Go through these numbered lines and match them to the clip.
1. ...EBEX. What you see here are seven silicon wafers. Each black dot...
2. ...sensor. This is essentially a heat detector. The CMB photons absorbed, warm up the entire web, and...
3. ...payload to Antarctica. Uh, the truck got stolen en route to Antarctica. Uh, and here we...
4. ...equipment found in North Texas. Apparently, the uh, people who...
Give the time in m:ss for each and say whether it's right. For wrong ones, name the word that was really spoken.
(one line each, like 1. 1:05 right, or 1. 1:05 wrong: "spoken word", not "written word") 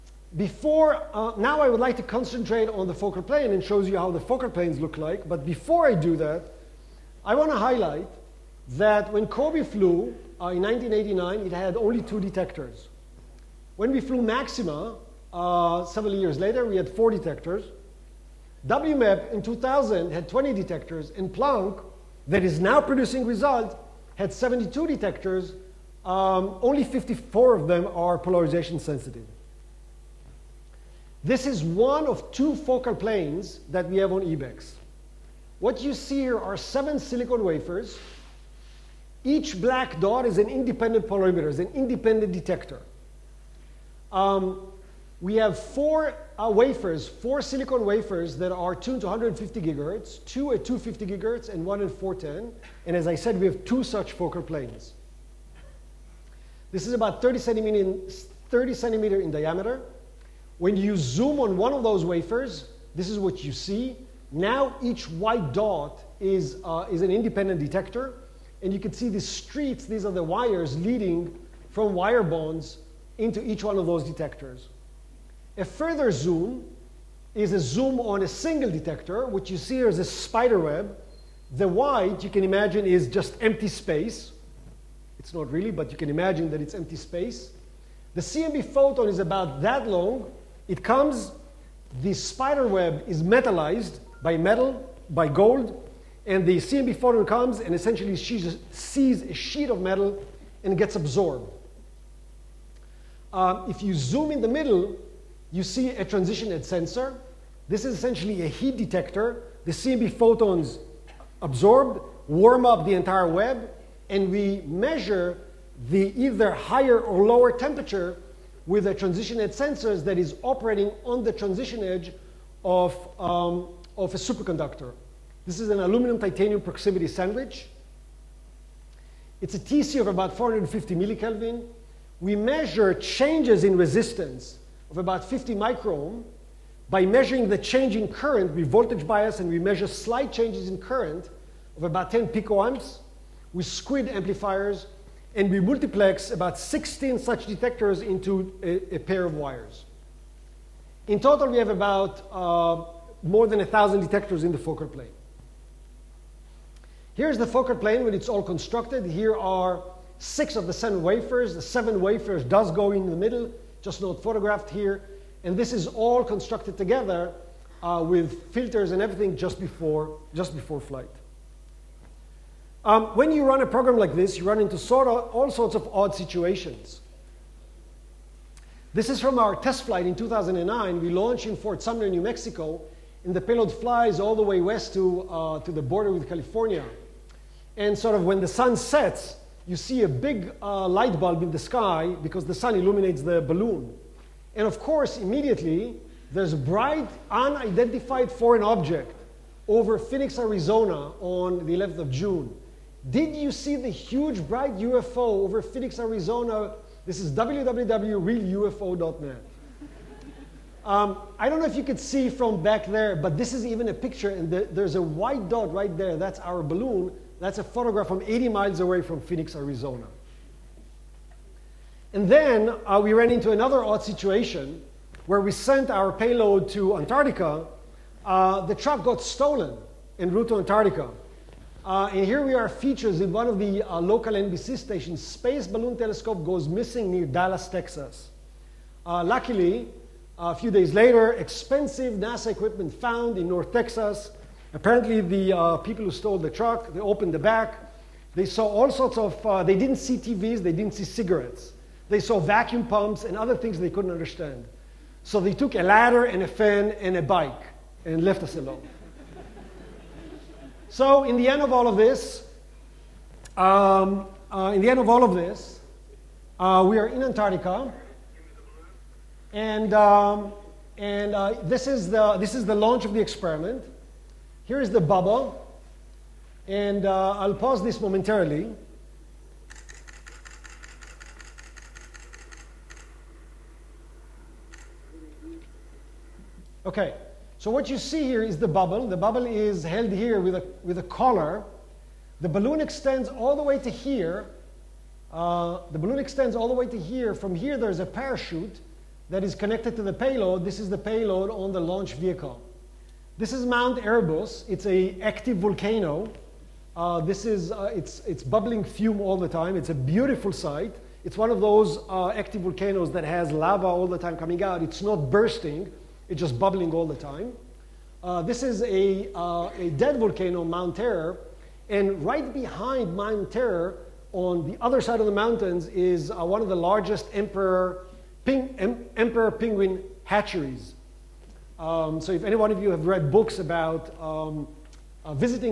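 1. 0:34 right
2. 1:46 right
3. 3:46 right
4. 4:02 right.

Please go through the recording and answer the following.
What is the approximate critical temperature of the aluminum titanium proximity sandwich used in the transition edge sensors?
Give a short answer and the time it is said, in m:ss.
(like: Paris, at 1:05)
450 millikelvin, at 2:10.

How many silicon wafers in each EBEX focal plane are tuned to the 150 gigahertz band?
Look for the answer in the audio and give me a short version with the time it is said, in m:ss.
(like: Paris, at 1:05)
4, at 0:45.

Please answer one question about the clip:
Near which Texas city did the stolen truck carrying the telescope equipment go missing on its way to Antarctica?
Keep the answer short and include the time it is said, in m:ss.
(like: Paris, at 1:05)
Dallas, at 3:57.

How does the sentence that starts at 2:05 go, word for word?
This is an aluminum titanium proximity sandwich.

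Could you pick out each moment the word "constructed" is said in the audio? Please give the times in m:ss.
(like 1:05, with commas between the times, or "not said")
2:38, 2:46.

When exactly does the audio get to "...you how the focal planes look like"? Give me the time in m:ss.
0:03.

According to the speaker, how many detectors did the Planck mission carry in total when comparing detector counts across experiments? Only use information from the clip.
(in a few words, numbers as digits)
72.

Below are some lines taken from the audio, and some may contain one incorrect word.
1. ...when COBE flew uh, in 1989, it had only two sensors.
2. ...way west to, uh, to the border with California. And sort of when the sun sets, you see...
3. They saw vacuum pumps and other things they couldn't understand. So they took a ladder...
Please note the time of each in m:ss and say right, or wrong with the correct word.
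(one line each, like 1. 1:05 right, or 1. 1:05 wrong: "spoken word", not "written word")
1. 0:09 wrong: "detectors", not "sensors"
2. 3:04 right
3. 4:12 right.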